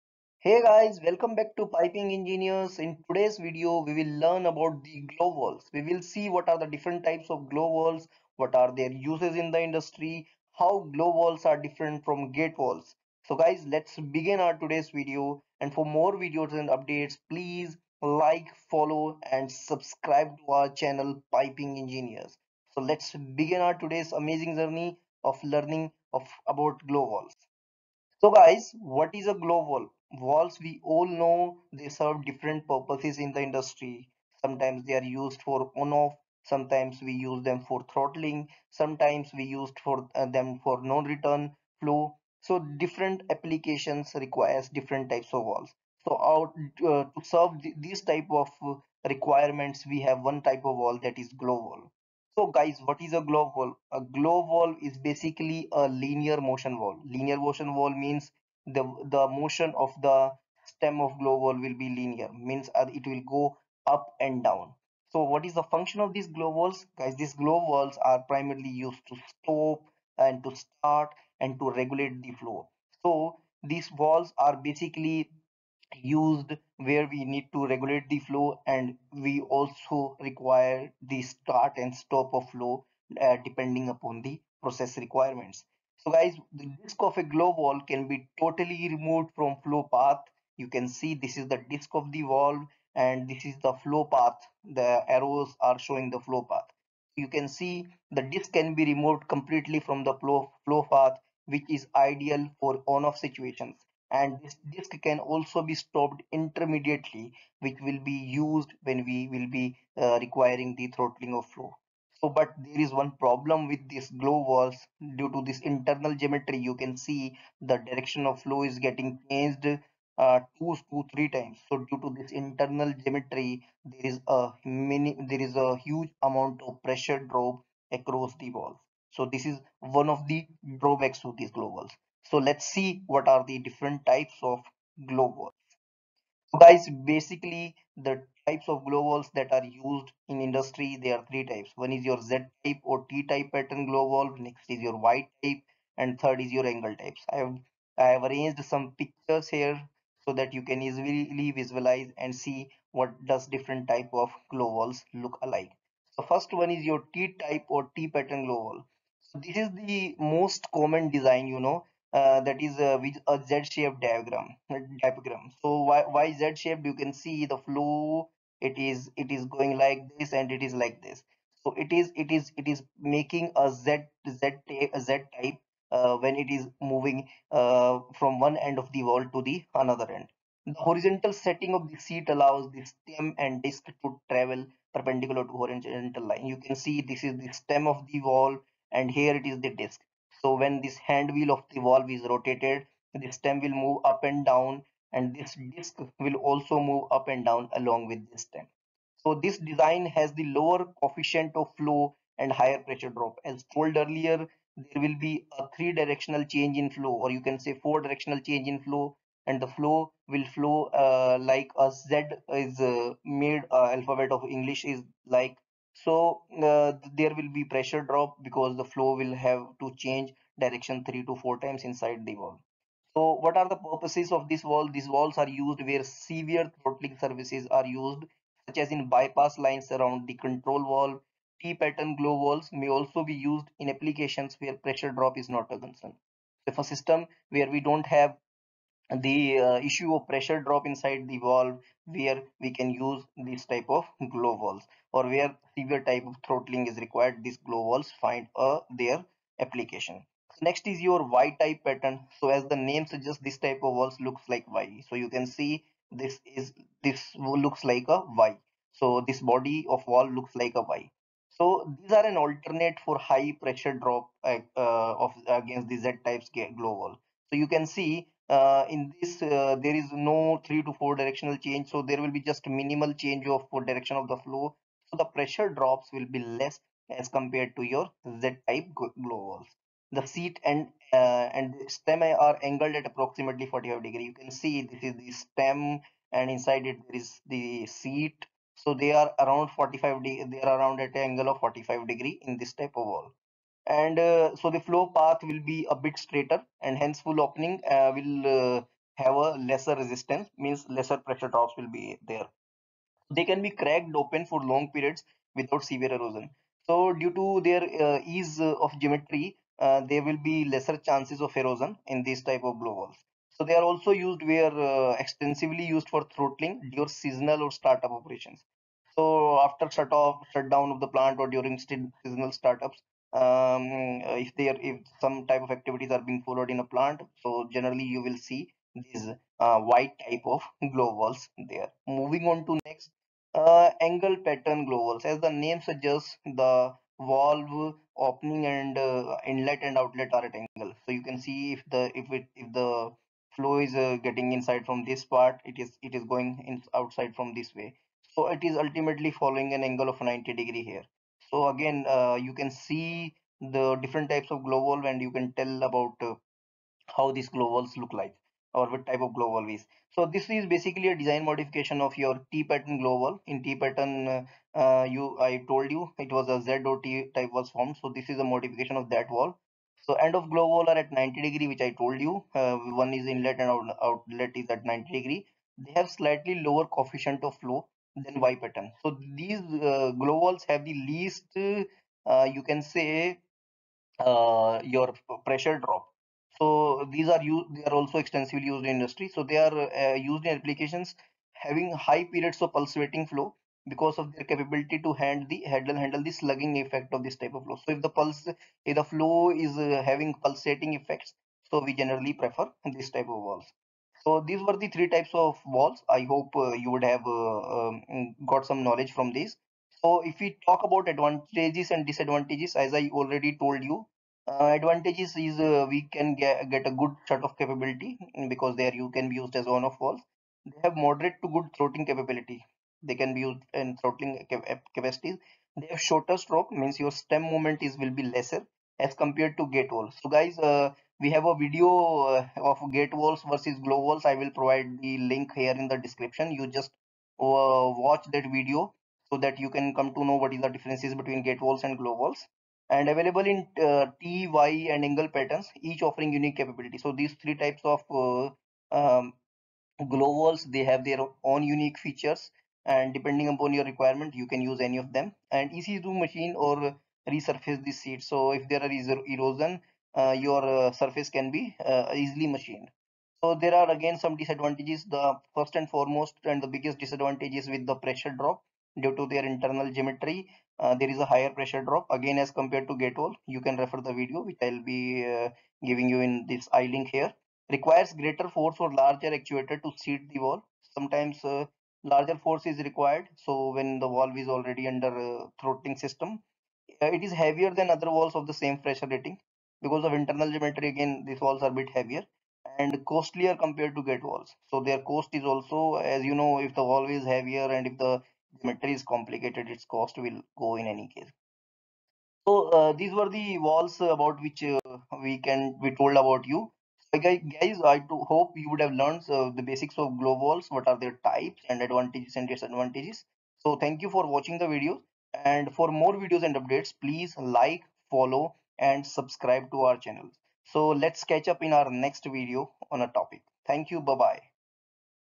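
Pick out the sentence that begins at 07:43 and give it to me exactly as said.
So there are again some disadvantages.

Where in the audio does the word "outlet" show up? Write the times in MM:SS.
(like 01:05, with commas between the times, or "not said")
05:39, 06:14.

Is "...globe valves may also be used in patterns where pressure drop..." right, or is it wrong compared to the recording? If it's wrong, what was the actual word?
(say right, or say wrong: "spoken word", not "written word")
wrong: "applications", not "patterns".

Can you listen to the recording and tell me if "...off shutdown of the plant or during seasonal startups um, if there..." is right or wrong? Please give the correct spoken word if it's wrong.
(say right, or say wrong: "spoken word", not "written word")
right.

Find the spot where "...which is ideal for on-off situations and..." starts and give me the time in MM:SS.
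01:41.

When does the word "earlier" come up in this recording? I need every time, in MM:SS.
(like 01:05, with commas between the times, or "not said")
03:23.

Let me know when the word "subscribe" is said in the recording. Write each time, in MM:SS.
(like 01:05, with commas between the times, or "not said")
00:19, 08:39.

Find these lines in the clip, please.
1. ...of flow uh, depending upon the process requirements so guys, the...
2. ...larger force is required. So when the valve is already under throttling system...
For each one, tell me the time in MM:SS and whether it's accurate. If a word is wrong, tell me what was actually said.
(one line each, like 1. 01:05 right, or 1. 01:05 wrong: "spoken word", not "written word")
1. 01:22 right
2. 08:02 right.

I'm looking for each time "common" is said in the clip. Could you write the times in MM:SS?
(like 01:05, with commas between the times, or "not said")
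02:40.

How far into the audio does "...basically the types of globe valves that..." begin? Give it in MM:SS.
02:17.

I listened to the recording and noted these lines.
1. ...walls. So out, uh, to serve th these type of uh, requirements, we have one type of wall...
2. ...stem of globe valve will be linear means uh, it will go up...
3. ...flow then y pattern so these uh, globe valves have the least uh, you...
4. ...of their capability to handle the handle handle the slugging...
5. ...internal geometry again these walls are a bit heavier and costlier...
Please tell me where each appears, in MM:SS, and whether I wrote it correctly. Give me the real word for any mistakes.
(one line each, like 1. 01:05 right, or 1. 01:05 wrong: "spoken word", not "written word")
1. 00:45 right
2. 01:00 right
3. 06:17 right
4. 06:34 right
5. 08:10 right.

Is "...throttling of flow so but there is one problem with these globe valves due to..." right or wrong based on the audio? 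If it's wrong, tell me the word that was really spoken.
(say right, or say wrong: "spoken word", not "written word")
right.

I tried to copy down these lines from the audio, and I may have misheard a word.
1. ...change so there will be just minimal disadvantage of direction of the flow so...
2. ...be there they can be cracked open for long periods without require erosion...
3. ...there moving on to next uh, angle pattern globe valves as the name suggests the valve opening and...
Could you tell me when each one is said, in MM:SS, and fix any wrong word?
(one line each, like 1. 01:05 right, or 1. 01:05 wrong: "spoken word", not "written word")
1. 04:31 wrong: "change", not "disadvantage"
2. 05:01 wrong: "severe", not "require"
3. 05:31 right.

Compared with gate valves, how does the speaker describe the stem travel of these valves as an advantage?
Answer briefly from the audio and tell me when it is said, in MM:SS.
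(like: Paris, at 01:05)
Shorter stroke, at 07:06.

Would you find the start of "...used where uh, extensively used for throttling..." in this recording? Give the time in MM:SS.
05:14.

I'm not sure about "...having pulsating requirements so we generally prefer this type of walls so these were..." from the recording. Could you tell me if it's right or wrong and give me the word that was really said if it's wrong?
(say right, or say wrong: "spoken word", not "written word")
wrong: "effects", not "requirements".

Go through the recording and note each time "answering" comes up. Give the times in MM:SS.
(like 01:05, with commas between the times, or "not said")
not said.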